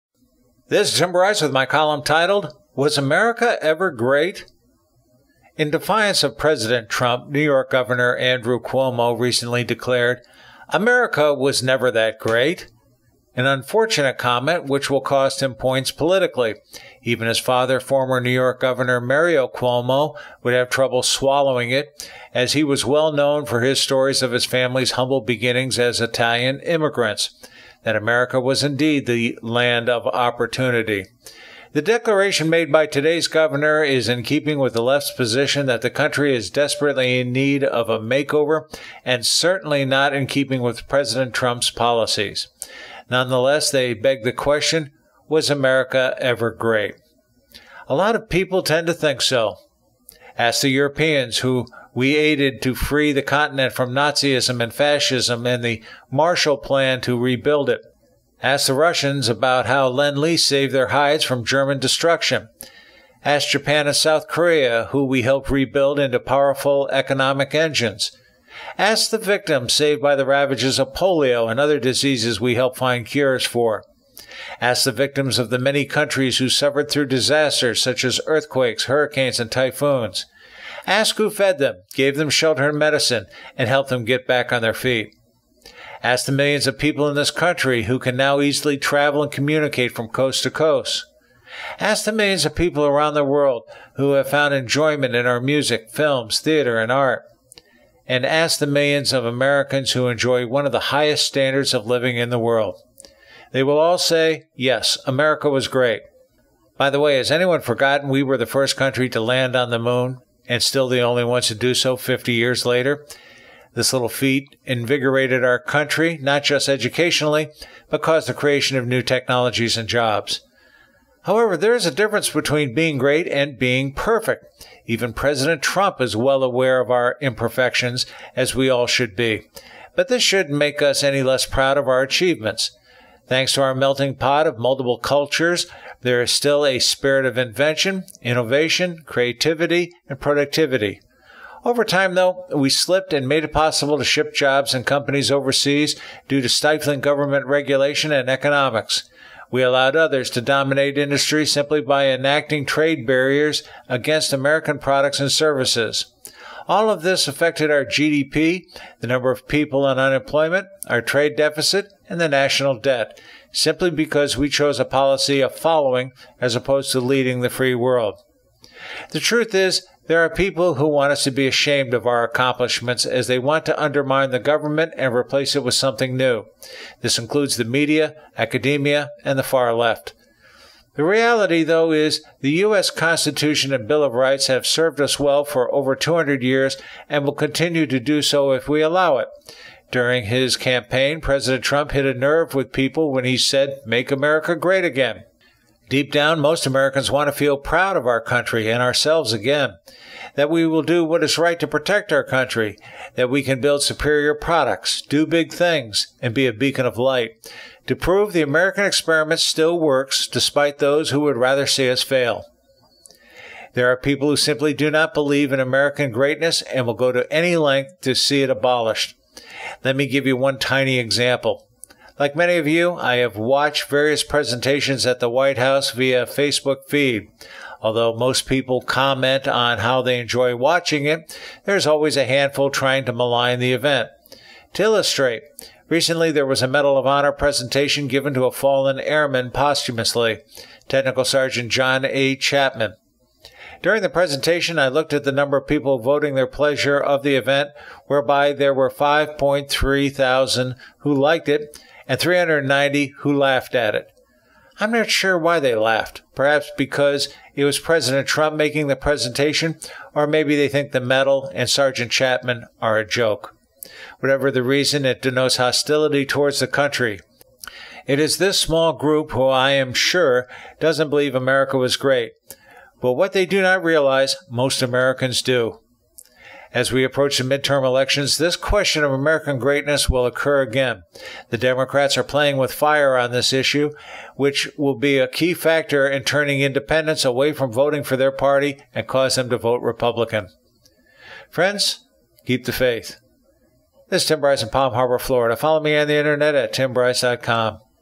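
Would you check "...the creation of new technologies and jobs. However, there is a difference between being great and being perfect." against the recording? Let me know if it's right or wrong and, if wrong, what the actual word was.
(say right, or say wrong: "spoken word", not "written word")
right.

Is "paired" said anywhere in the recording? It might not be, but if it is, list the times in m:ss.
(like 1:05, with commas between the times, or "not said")
not said.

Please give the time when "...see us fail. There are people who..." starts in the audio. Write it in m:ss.
3:31.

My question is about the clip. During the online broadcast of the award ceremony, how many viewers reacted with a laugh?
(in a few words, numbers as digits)
390.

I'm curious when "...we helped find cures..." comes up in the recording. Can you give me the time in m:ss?
1:12.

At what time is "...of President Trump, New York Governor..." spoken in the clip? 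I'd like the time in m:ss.
0:06.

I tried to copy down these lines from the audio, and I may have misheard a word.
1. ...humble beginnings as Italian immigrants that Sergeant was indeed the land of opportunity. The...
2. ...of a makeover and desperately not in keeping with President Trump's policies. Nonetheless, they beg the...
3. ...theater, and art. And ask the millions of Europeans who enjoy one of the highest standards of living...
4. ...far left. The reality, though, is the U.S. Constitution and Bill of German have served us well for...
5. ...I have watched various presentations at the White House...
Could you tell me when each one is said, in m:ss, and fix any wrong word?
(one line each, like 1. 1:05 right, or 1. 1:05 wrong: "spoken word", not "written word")
1. 0:24 wrong: "America", not "Sergeant"
2. 0:37 wrong: "certainly", not "desperately"
3. 1:36 wrong: "Americans", not "Europeans"
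4. 2:59 wrong: "Rights", not "German"
5. 3:42 right.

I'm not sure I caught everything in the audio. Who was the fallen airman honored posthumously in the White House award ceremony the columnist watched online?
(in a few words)
John A. Chapman.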